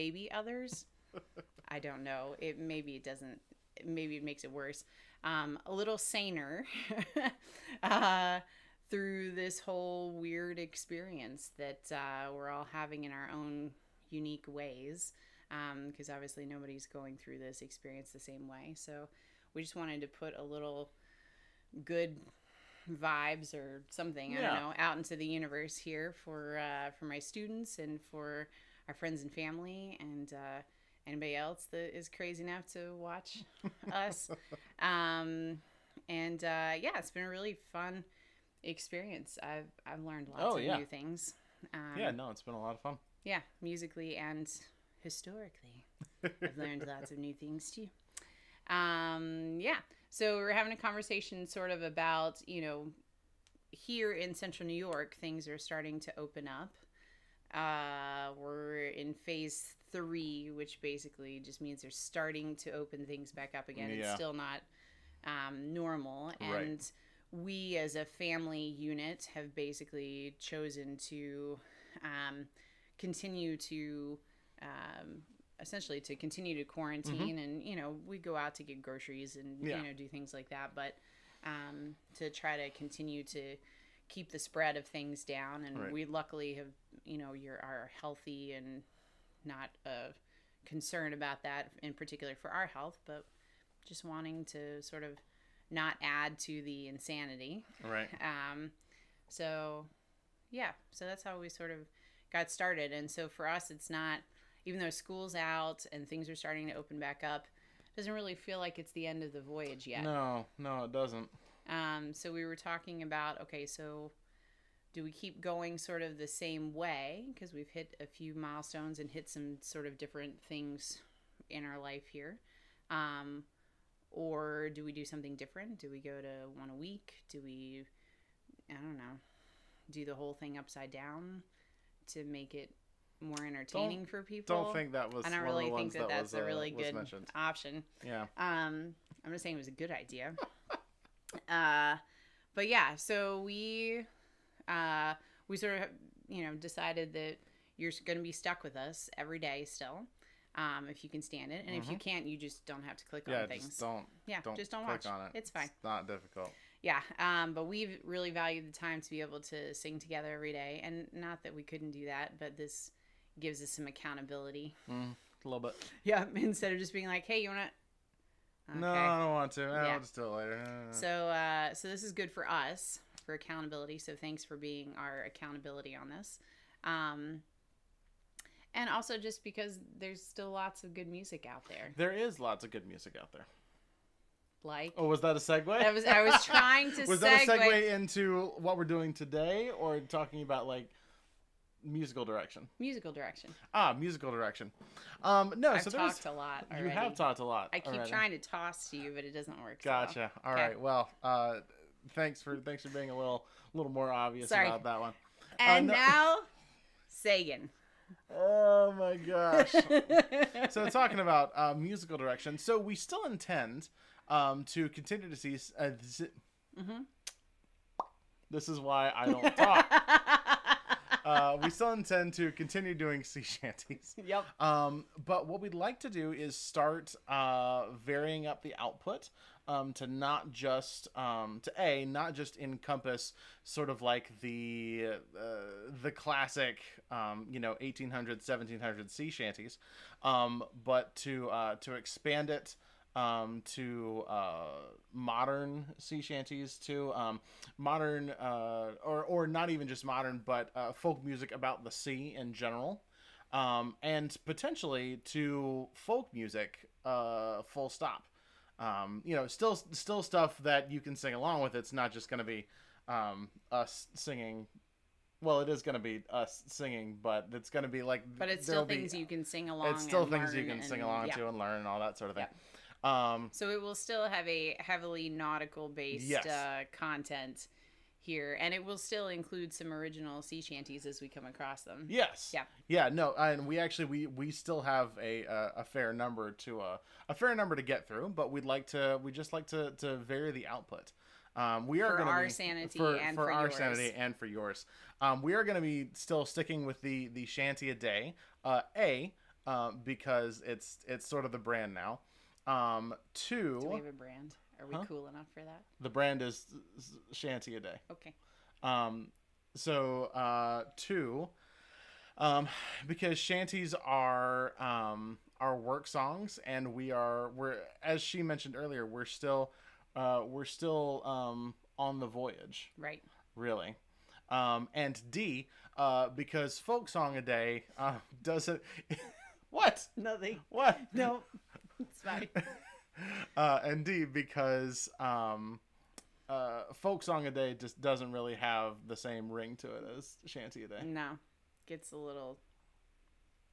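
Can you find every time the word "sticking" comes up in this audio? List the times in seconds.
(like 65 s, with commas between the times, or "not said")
296 s.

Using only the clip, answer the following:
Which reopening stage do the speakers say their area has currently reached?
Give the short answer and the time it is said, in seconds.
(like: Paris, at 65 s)
Phase 3, at 59 s.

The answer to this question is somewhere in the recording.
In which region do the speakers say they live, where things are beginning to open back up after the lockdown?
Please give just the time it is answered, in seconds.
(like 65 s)
54 s.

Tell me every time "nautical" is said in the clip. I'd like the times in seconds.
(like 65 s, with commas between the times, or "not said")
275 s.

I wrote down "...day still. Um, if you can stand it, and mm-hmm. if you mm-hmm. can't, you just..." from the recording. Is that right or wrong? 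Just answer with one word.
right.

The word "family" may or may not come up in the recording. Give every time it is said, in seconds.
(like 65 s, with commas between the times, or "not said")
29 s, 68 s.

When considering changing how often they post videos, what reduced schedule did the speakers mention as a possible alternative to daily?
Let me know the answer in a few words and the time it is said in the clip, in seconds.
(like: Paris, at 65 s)
One a week, at 126 s.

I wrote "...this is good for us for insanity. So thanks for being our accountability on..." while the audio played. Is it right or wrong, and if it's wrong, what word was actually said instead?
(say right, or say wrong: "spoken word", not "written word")
wrong: "accountability", not "insanity".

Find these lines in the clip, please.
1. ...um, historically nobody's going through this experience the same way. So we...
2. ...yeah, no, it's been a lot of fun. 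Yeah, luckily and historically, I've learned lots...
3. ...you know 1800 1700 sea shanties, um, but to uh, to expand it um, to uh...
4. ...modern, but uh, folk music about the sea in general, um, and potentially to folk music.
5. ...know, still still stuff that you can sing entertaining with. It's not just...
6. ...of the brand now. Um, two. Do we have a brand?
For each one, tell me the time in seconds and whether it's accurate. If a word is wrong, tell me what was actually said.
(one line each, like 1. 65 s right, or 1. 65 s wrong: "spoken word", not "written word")
1. 16 s wrong: "obviously", not "historically"
2. 41 s wrong: "musically", not "luckily"
3. 237 s right
4. 250 s right
5. 259 s wrong: "along", not "entertaining"
6. 301 s right.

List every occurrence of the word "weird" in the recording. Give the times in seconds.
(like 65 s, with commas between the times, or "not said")
10 s.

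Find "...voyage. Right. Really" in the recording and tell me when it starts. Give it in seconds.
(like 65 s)
322 s.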